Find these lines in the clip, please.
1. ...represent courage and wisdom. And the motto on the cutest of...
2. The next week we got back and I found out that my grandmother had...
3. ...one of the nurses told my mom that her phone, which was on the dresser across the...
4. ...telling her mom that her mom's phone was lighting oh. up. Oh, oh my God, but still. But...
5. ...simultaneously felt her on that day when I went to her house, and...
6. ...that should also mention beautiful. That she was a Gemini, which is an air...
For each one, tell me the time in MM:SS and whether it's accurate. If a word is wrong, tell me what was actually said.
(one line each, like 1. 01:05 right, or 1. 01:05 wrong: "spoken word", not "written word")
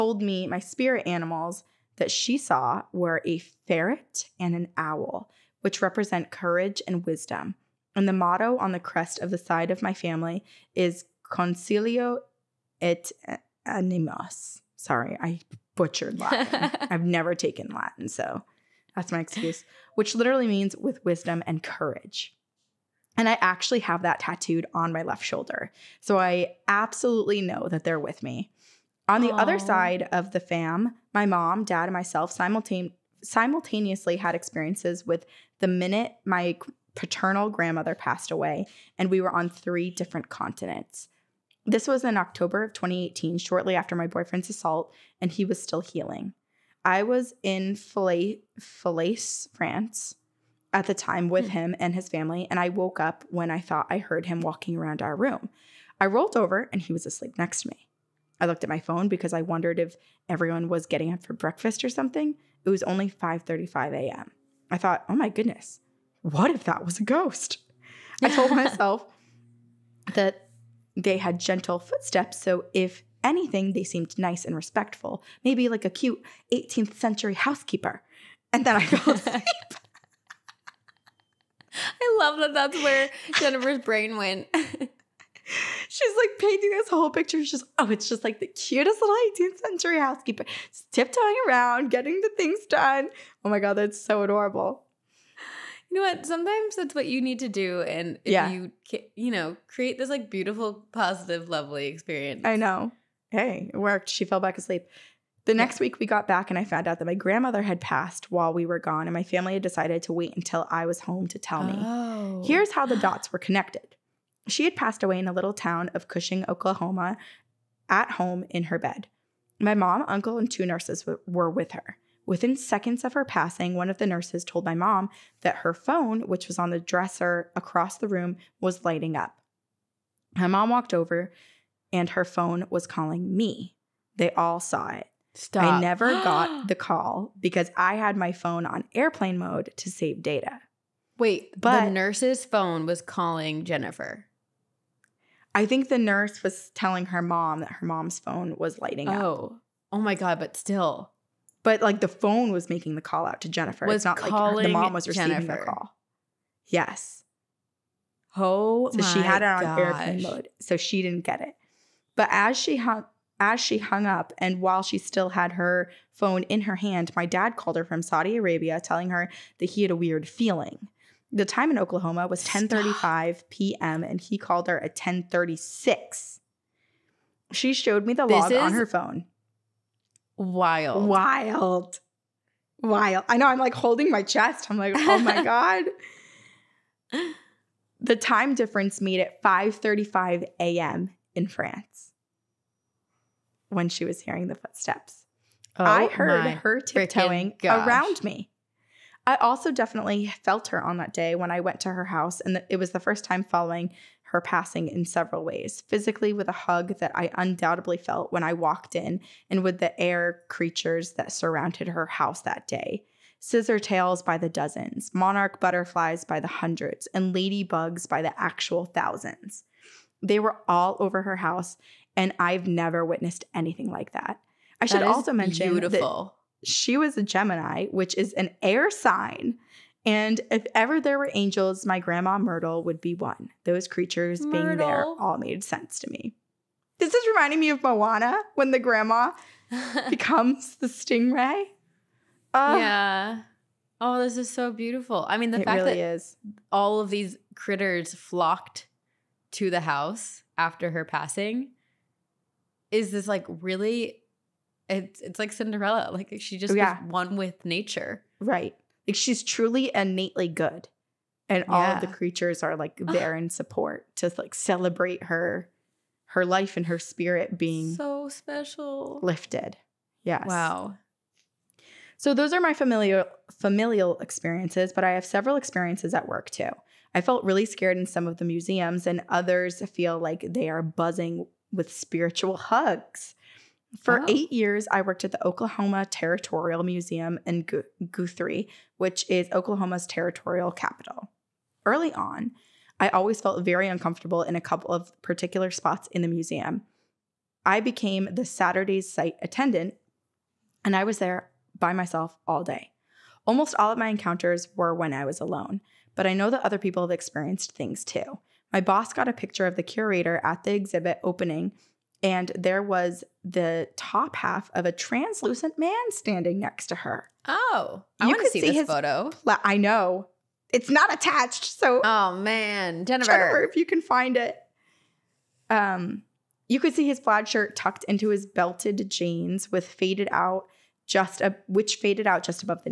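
1. 00:05 wrong: "crest", not "cutest"
2. 01:45 right
3. 02:03 right
4. 02:26 right
5. 03:19 wrong: "definitely", not "simultaneously"
6. 03:44 right.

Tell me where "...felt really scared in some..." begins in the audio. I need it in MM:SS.
04:37.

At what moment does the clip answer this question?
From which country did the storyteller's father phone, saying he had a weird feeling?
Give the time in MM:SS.
02:48.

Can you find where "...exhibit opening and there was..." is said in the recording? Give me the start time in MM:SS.
05:10.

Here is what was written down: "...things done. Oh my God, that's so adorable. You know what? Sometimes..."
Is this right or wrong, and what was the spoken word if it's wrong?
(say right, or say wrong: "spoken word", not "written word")
right.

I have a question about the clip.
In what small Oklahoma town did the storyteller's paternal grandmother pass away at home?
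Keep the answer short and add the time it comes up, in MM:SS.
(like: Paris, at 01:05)
Cushing, at 01:56.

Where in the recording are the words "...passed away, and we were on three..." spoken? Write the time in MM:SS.
00:37.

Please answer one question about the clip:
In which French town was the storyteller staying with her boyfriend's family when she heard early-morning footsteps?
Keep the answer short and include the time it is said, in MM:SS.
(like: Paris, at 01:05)
Falaise, at 00:47.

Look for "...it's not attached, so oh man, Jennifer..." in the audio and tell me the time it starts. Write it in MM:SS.
05:20.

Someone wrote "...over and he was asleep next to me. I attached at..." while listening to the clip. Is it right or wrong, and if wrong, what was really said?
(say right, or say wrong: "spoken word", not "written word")
wrong: "looked", not "attached".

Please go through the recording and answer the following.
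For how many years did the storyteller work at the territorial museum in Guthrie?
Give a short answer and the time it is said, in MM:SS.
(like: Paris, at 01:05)
8, at 04:44.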